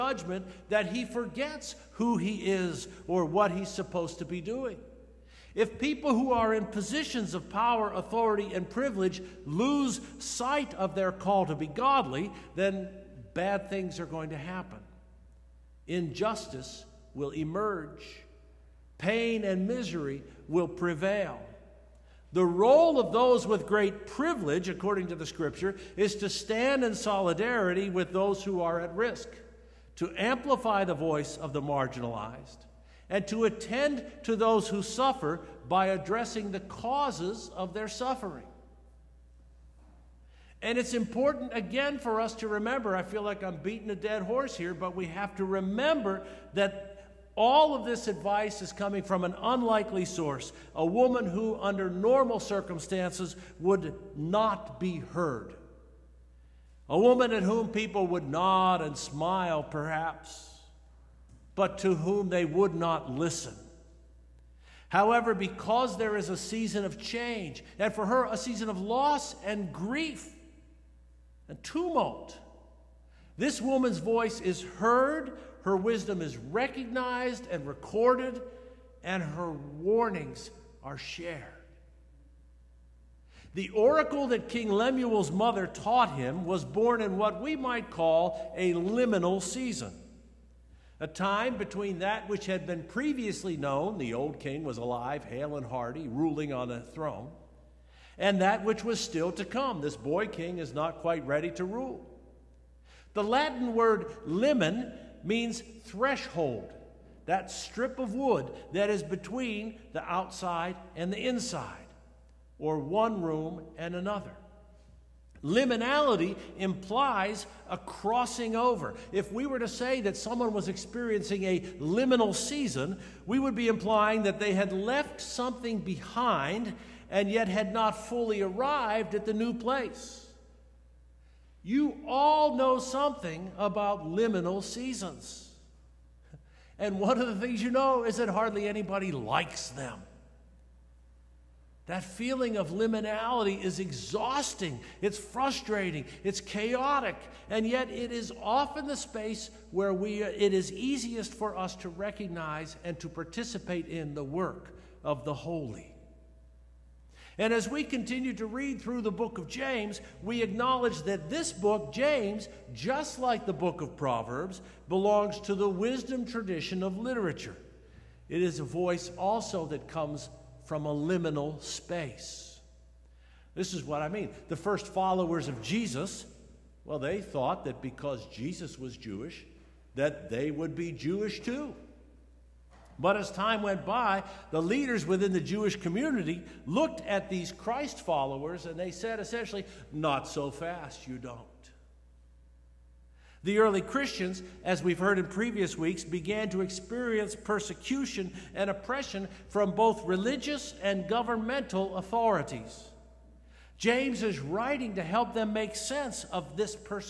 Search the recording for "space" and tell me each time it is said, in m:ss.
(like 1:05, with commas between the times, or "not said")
2:28, 2:51.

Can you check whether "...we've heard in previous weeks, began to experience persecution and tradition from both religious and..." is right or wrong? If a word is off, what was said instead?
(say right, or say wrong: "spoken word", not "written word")
wrong: "oppression", not "tradition".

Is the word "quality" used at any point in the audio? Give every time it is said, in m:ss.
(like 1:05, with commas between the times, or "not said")
not said.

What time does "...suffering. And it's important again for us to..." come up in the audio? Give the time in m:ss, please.
0:37.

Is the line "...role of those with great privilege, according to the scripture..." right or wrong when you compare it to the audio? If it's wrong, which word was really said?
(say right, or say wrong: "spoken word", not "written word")
right.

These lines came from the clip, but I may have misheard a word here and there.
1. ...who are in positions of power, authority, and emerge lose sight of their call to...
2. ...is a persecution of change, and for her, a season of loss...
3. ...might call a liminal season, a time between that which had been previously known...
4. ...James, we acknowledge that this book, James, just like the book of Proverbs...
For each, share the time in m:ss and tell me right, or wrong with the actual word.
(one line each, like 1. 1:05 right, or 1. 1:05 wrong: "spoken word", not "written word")
1. 0:06 wrong: "privilege", not "emerge"
2. 1:06 wrong: "season", not "persecution"
3. 1:27 right
4. 2:39 right.